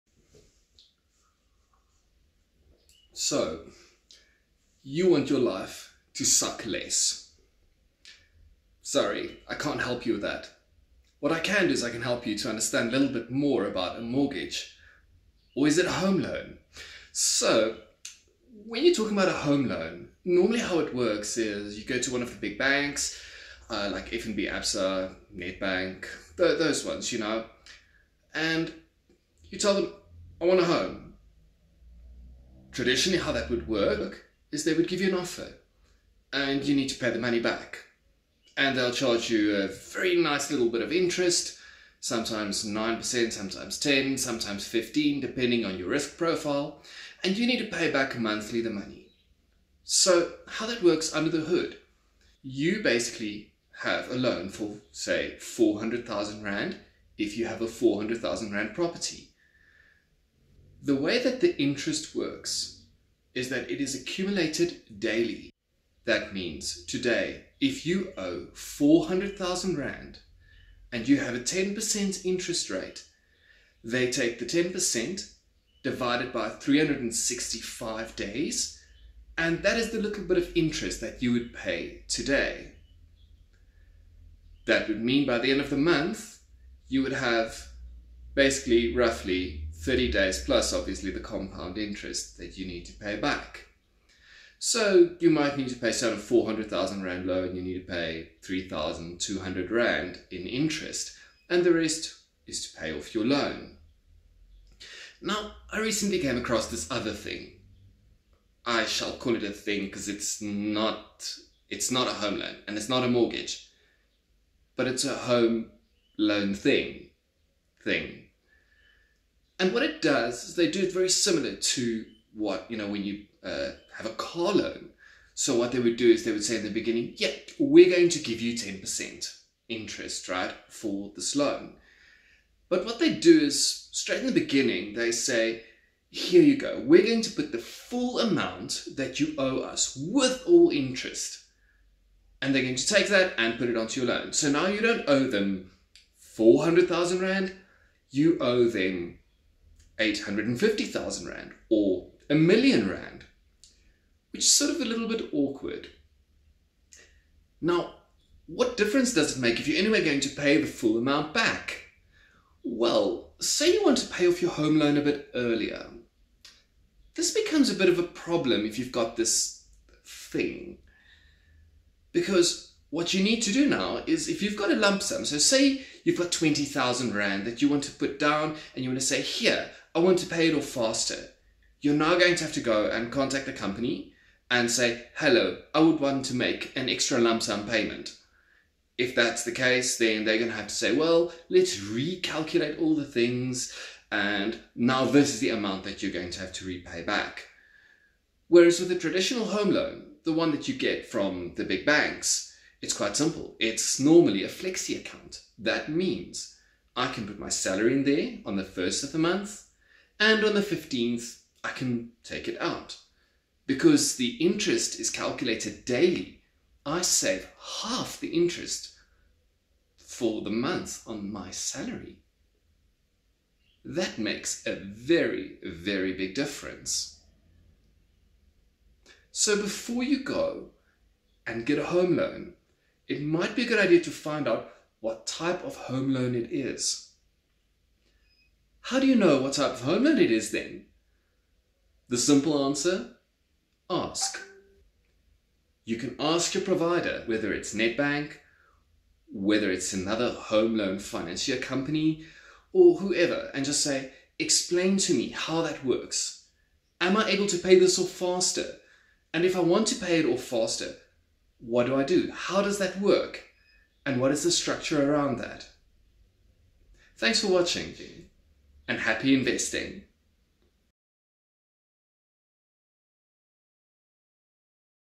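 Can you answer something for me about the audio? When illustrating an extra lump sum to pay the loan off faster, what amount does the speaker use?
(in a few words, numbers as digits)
20,000 Rand.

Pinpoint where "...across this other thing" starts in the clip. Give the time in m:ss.
1:46.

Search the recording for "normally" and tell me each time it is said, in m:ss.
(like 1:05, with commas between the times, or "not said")
0:20, 3:23.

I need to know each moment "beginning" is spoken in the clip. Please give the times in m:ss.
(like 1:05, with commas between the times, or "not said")
2:06, 2:14.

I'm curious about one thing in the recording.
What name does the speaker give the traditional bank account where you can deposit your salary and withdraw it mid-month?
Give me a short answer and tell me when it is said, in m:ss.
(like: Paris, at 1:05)
flexi account, at 3:24.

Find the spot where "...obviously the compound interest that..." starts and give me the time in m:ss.
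1:30.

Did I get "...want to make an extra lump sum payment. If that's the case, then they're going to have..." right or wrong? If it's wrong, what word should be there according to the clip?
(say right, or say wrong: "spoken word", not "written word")
right.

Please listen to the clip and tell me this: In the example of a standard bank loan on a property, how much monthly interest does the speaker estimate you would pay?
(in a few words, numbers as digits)
3,200 Rand.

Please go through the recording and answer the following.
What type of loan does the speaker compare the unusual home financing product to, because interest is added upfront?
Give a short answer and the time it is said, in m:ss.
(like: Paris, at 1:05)
car loan, at 2:04.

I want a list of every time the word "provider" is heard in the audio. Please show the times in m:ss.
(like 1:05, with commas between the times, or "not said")
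4:06.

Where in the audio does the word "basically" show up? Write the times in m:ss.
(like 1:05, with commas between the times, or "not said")
0:52, 1:28.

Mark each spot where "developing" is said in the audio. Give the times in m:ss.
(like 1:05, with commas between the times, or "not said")
not said.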